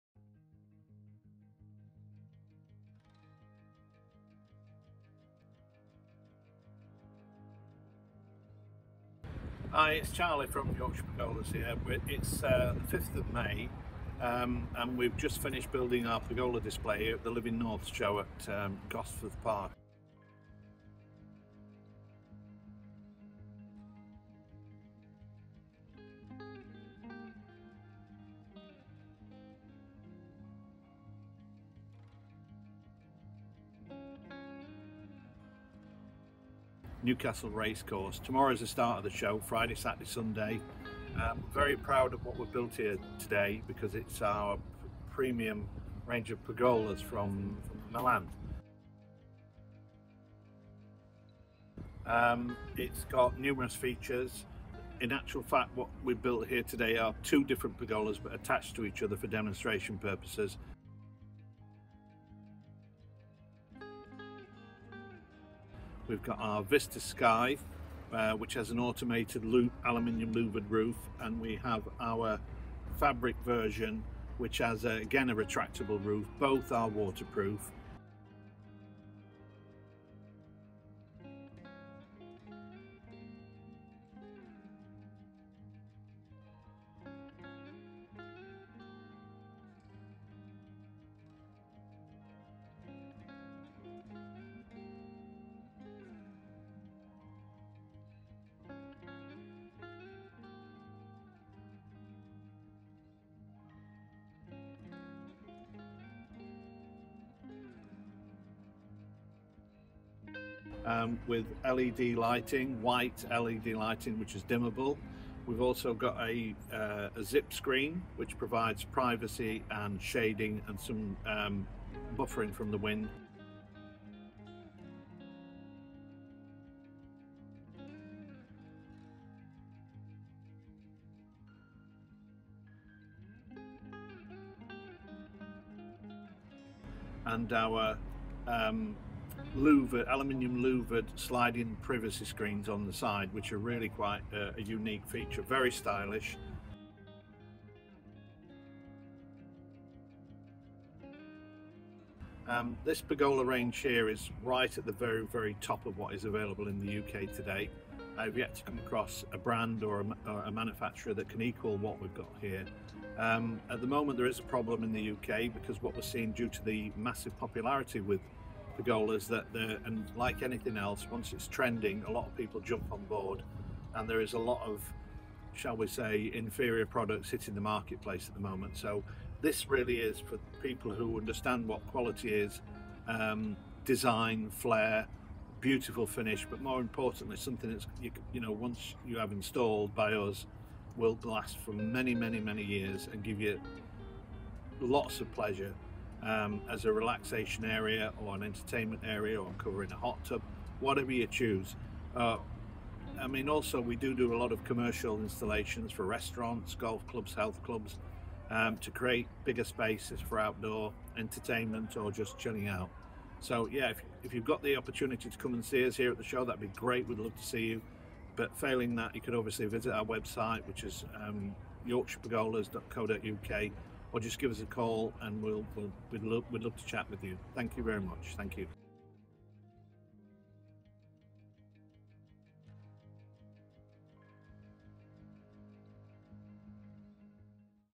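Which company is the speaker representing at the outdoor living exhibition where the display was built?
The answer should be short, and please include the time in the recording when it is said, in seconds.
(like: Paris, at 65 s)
Yorkshire Pergolas, at 10 s.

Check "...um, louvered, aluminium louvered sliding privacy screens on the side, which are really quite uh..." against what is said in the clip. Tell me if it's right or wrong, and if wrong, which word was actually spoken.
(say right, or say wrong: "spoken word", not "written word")
right.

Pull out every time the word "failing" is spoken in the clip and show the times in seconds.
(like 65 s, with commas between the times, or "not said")
218 s.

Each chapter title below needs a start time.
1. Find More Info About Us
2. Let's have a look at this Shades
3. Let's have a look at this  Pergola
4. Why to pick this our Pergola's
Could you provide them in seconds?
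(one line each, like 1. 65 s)
1. 213 s
2. 138 s
3. 48 s
4. 151 s.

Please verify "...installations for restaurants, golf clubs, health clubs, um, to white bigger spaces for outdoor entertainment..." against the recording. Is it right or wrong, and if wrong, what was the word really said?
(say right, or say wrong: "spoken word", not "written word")
wrong: "create", not "white".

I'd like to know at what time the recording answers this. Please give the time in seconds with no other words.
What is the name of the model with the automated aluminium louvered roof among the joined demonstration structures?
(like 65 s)
66 s.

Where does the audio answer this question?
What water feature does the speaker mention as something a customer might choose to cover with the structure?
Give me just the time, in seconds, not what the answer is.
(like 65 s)
199 s.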